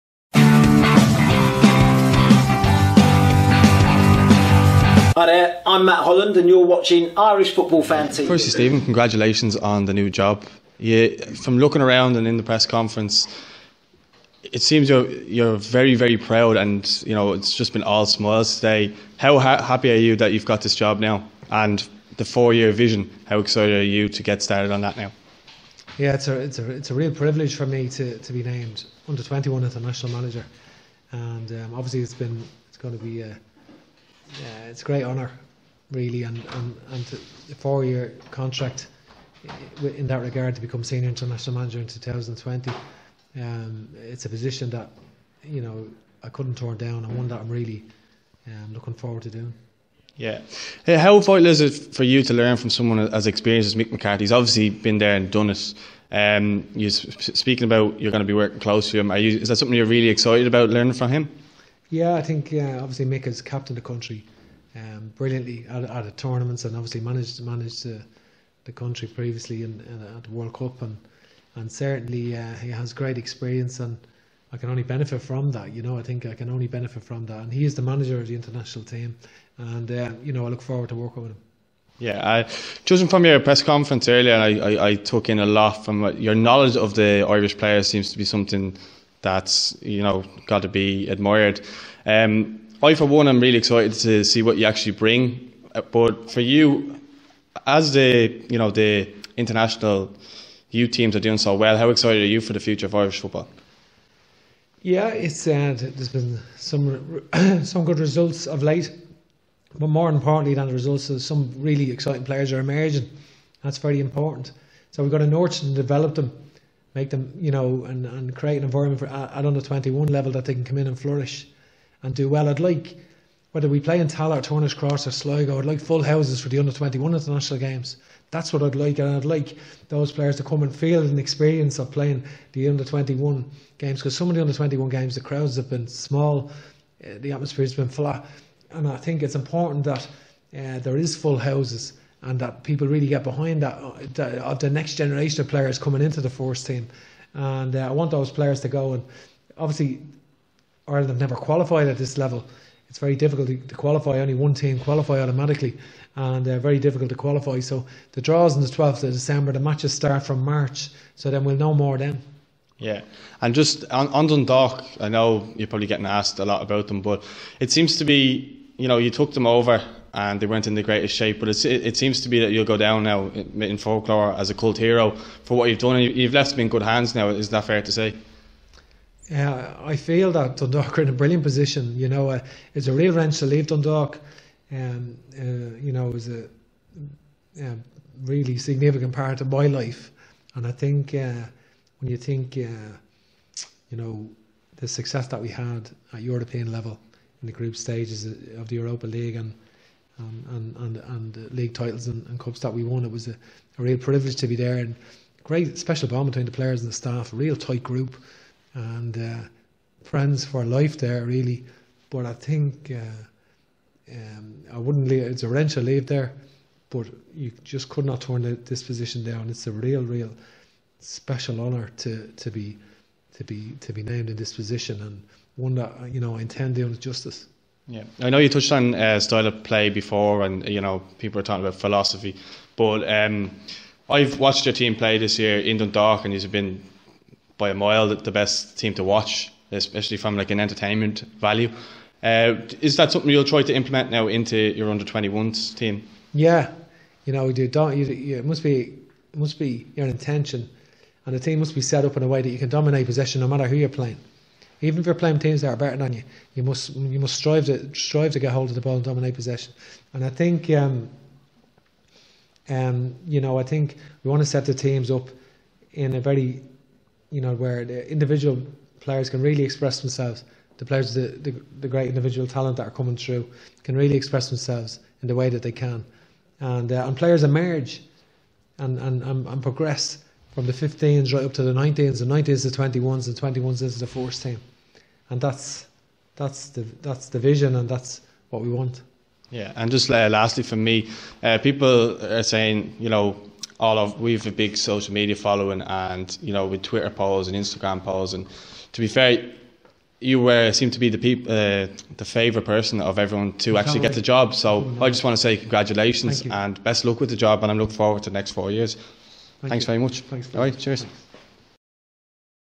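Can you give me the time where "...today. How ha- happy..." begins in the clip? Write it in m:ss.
0:18.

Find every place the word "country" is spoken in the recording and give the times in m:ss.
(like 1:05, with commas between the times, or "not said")
1:03, 1:08.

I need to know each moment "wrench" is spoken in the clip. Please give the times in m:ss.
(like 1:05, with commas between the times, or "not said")
3:03, 3:35.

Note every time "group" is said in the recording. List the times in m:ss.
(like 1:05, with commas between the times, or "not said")
3:17, 3:27.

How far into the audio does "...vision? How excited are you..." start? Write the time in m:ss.
0:22.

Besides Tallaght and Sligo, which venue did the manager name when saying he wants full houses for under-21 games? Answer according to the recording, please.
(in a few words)
Turner's Cross.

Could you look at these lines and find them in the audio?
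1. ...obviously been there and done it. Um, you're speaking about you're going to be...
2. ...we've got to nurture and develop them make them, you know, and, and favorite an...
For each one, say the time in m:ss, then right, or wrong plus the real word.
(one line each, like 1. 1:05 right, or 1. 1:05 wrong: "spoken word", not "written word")
1. 0:54 right
2. 1:55 wrong: "create", not "favorite".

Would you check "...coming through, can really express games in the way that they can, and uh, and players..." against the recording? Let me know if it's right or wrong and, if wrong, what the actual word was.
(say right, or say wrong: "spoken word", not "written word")
wrong: "themselves", not "games".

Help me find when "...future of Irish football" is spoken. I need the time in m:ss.
1:42.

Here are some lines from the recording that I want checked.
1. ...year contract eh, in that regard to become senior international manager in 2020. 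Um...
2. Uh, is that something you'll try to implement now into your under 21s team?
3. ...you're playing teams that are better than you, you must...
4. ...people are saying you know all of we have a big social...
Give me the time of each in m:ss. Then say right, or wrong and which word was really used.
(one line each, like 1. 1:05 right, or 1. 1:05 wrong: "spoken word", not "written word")
1. 0:37 right
2. 4:02 right
3. 4:15 right
4. 4:51 right.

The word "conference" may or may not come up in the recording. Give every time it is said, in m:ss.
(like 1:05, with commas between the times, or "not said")
0:12, 1:23.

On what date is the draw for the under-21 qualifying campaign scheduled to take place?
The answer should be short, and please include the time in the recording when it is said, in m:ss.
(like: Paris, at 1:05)
12th of December, at 2:38.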